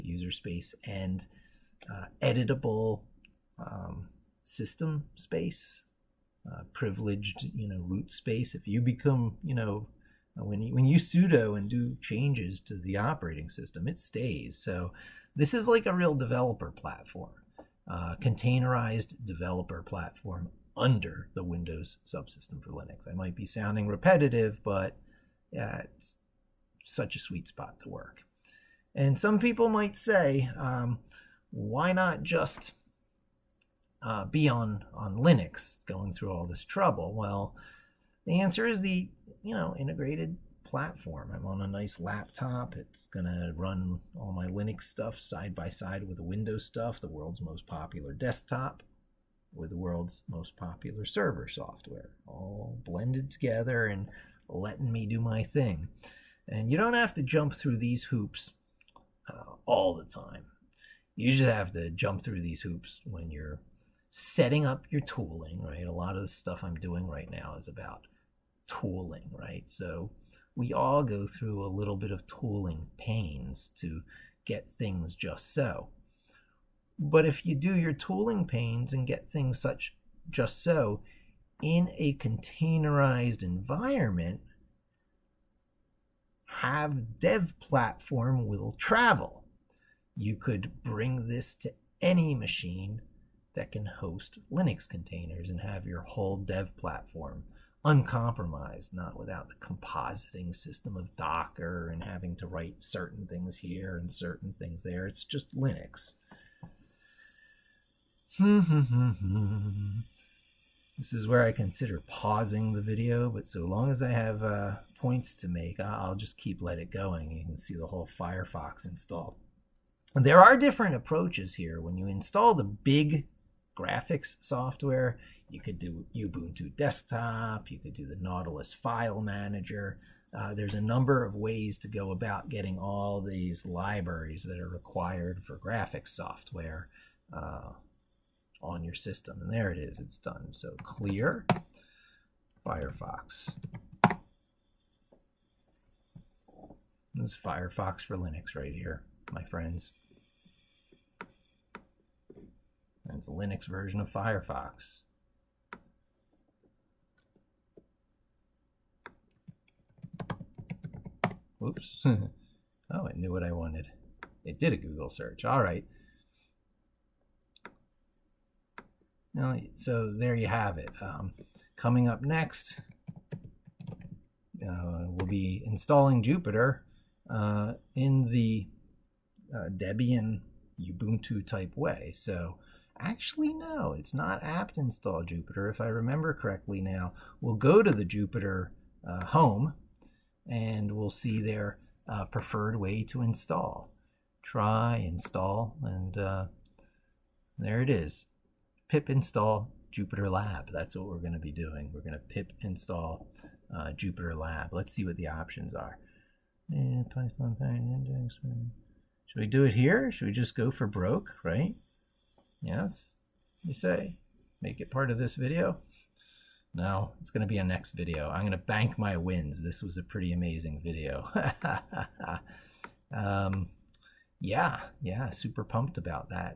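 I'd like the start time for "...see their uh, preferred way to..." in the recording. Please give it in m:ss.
3:11.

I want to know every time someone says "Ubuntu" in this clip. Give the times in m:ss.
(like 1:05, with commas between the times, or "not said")
2:06, 3:00.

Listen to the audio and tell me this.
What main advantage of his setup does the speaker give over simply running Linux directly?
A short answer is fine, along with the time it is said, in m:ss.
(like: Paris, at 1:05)
integrated platform, at 0:39.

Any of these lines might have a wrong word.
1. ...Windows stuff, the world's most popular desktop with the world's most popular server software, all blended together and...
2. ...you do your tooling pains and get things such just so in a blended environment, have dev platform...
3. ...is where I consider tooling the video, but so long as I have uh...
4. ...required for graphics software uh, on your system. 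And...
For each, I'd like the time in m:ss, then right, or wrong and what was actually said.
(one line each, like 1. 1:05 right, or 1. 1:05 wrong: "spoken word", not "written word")
1. 0:46 right
2. 1:17 wrong: "containerized", not "blended"
3. 1:51 wrong: "pausing", not "tooling"
4. 2:14 right.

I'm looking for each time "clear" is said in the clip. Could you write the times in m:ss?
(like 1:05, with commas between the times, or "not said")
2:20.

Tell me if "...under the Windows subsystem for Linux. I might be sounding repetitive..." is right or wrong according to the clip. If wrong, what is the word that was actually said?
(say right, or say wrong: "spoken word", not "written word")
right.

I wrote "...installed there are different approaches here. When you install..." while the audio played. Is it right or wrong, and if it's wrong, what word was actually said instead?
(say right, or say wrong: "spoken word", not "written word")
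right.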